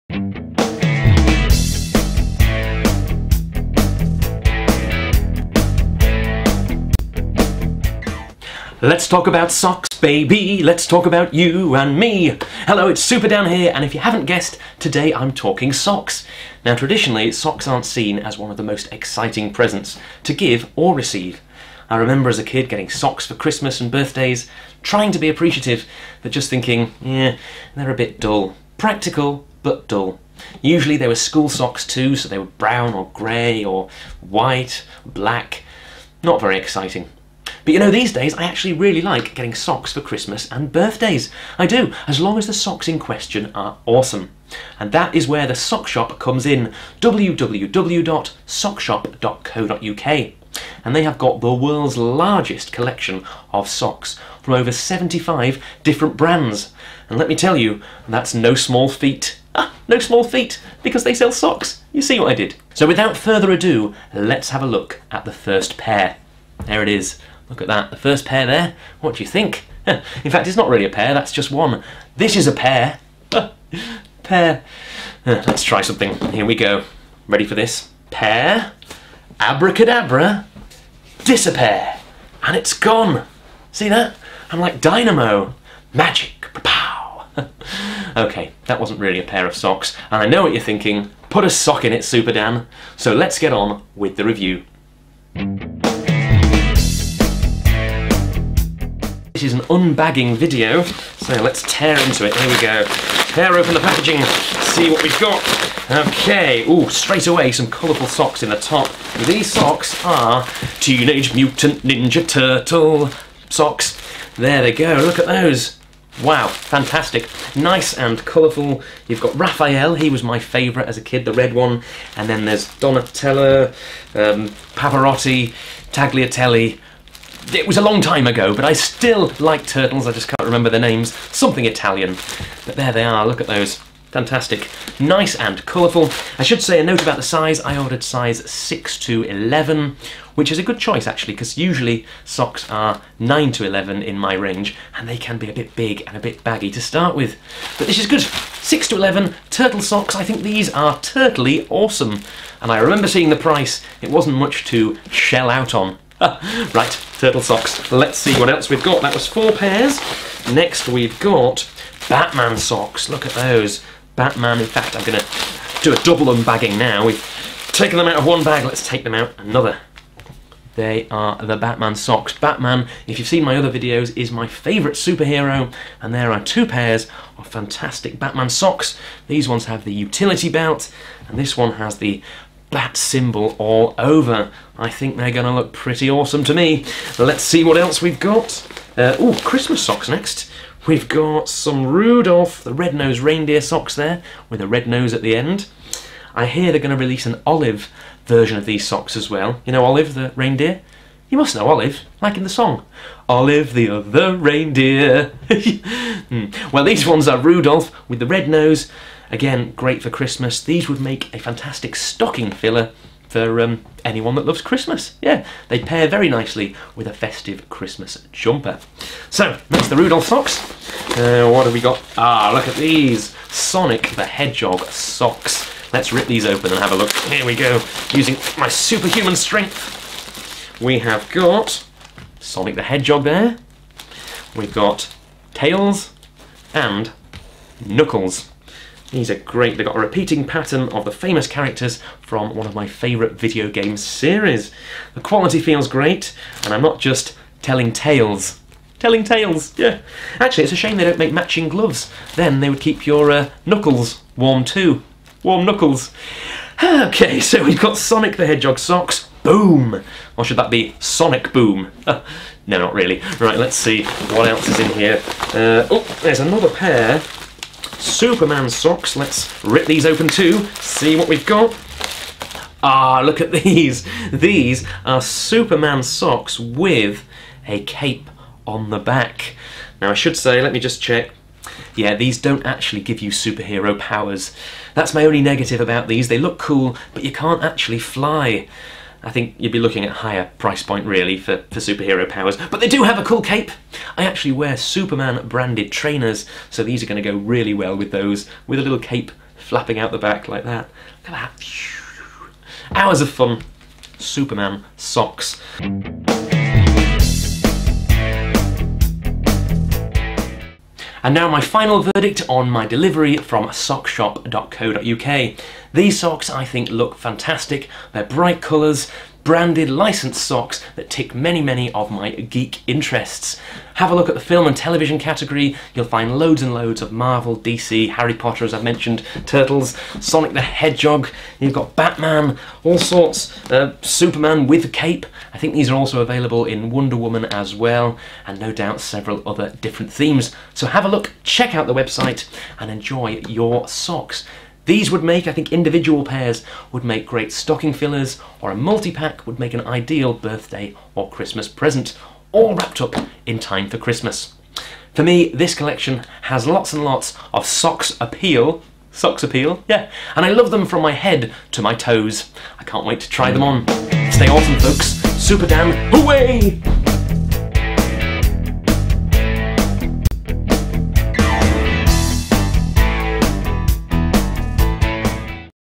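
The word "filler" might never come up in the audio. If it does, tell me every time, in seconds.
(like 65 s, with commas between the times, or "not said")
212 s, 347 s.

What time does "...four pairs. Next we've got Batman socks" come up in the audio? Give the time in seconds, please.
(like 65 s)
159 s.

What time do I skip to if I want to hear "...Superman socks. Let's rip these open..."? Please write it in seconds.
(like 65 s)
268 s.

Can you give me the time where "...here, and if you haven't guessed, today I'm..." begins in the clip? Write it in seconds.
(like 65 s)
13 s.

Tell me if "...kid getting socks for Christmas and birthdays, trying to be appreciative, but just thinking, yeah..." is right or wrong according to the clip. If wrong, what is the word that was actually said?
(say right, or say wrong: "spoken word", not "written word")
right.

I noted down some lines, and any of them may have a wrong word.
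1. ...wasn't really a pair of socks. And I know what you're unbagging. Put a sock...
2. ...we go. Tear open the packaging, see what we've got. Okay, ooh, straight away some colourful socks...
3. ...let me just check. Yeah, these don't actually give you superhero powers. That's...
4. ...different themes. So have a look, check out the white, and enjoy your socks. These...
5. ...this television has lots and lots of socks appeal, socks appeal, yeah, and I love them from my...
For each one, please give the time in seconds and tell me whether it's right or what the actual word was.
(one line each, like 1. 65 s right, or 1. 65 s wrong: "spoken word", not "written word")
1. 88 s wrong: "thinking", not "unbagging"
2. 102 s right
3. 280 s right
4. 339 s wrong: "website", not "white"
5. 355 s wrong: "collection", not "television".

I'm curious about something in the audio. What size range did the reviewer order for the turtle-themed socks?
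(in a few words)
6 to 11.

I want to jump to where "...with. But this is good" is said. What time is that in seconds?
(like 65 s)
147 s.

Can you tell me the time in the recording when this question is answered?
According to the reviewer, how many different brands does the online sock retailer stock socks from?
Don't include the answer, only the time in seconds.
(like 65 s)
54 s.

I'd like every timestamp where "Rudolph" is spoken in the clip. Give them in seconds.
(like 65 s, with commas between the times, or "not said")
191 s, 207 s, 219 s.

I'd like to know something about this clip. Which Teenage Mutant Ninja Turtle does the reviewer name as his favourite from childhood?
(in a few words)
Raphael.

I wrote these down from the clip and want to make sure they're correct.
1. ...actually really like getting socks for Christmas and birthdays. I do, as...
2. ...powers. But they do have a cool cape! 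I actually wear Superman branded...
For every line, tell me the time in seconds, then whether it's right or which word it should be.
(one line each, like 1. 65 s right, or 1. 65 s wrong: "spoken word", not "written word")
1. 38 s right
2. 292 s right.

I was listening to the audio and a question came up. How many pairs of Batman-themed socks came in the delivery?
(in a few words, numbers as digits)
2.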